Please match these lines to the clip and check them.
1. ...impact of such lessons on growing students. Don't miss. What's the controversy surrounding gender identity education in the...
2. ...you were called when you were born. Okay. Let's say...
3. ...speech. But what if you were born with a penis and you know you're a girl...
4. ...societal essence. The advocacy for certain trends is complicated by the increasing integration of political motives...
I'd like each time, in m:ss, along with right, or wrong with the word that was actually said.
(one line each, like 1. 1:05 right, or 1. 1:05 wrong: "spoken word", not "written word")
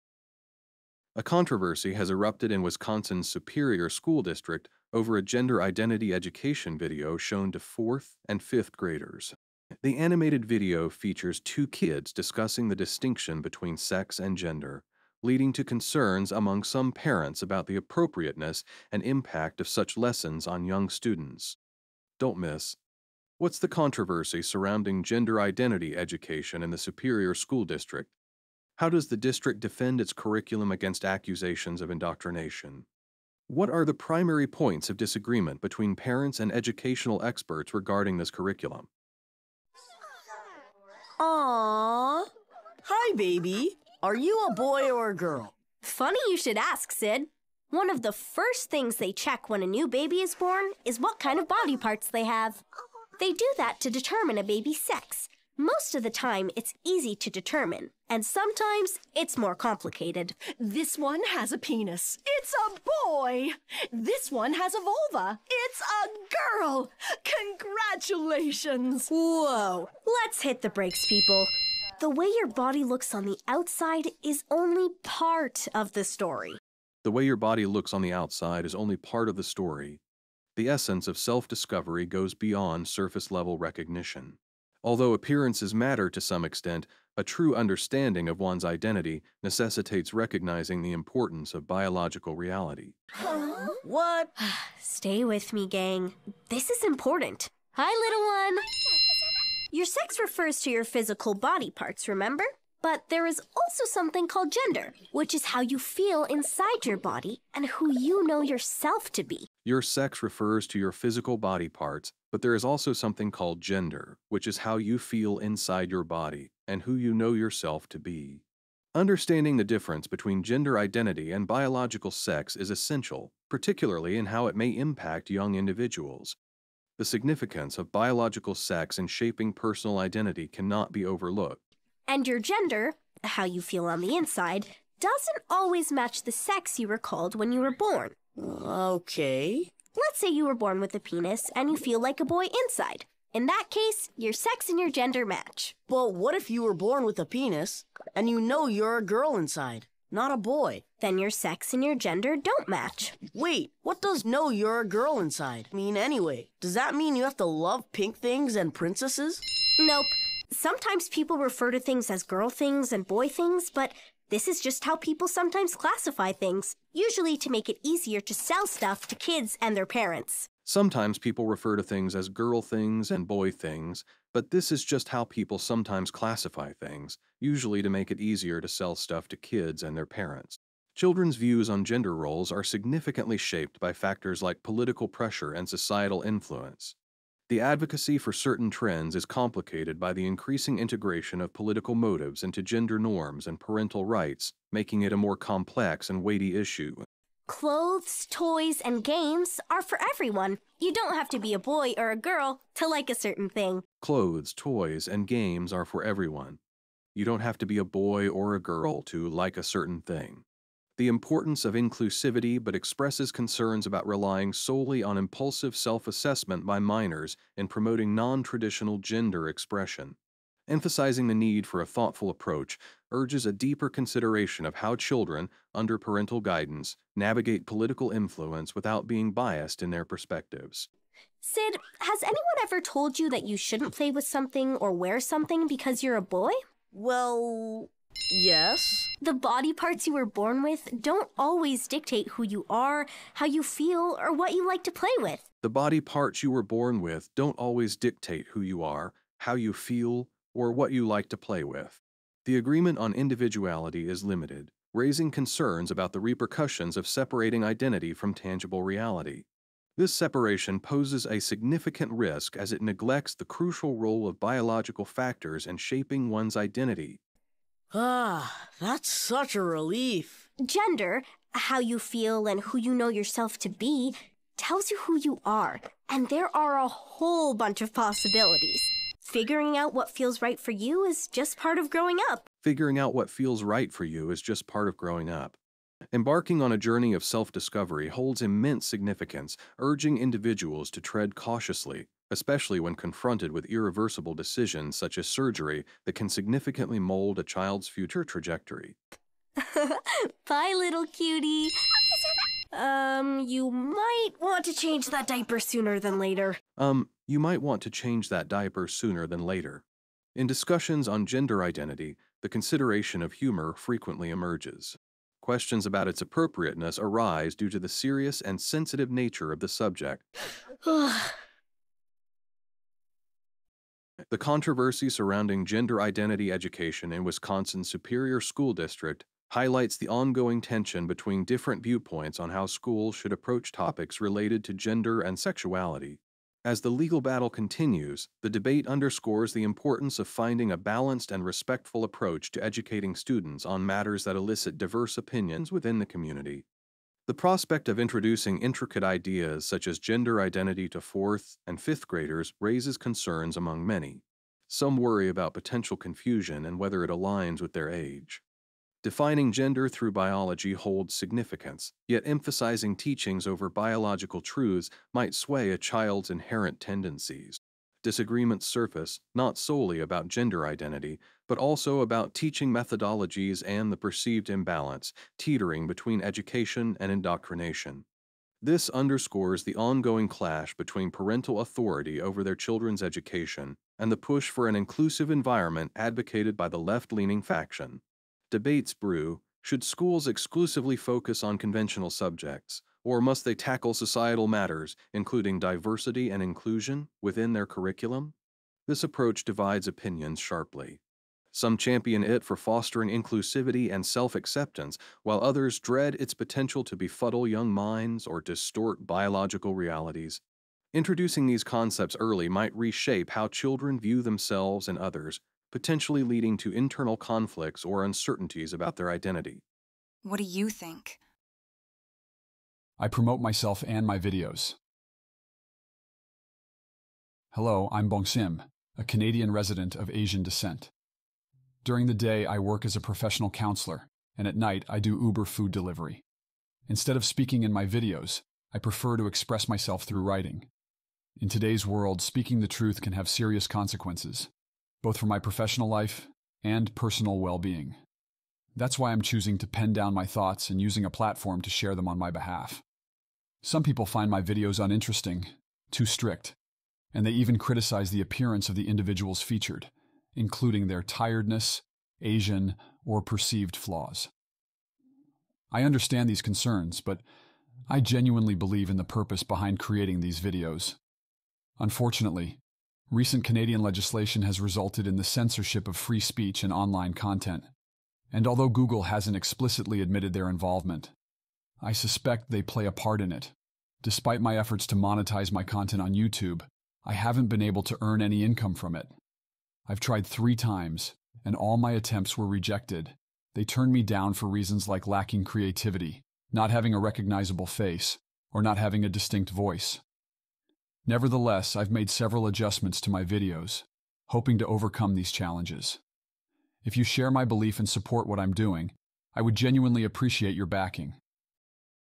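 1. 0:19 wrong: "young", not "growing"
2. 2:16 right
3. 2:25 wrong: "match", not "speech"
4. 3:05 wrong: "influence", not "essence".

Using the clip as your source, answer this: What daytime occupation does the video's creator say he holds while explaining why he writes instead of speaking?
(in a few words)
professional counselor.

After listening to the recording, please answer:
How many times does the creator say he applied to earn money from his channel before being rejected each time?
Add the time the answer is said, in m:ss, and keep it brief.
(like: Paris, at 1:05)
3, at 8:10.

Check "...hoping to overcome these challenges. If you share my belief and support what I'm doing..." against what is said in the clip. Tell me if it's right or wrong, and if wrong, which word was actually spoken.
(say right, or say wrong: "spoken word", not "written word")
right.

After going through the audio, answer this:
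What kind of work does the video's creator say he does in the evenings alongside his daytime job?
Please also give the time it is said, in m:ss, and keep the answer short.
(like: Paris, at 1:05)
Uber food delivery, at 7:15.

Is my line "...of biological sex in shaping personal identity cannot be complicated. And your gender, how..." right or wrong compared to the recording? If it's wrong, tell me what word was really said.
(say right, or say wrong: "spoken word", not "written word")
wrong: "overlooked", not "complicated".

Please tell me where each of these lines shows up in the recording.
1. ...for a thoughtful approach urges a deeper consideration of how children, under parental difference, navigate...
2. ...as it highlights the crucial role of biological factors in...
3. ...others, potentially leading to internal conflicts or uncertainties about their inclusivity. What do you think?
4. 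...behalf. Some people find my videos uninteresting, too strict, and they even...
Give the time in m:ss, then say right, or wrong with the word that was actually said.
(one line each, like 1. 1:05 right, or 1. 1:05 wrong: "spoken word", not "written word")
1. 3:41 wrong: "guidance", not "difference"
2. 4:22 wrong: "neglects", not "highlights"
3. 6:54 wrong: "identity", not "inclusivity"
4. 7:32 right.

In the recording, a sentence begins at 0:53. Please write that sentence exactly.
They do that to determine a baby's sex, most of the time, it's easy to determine, and sometimes it's more complicated.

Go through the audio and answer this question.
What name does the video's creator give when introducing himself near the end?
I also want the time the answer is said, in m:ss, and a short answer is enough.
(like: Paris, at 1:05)
Bong Sim, at 7:08.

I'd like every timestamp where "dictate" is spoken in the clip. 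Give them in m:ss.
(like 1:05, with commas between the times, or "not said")
4:01, 4:07.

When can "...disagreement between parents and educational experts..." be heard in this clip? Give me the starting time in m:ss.
0:34.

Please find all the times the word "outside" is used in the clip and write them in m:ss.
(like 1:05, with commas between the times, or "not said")
1:13, 1:18.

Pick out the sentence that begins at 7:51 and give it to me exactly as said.
Unfortunately, recent Canadian legislation has resulted in the censorship of free speech and online content.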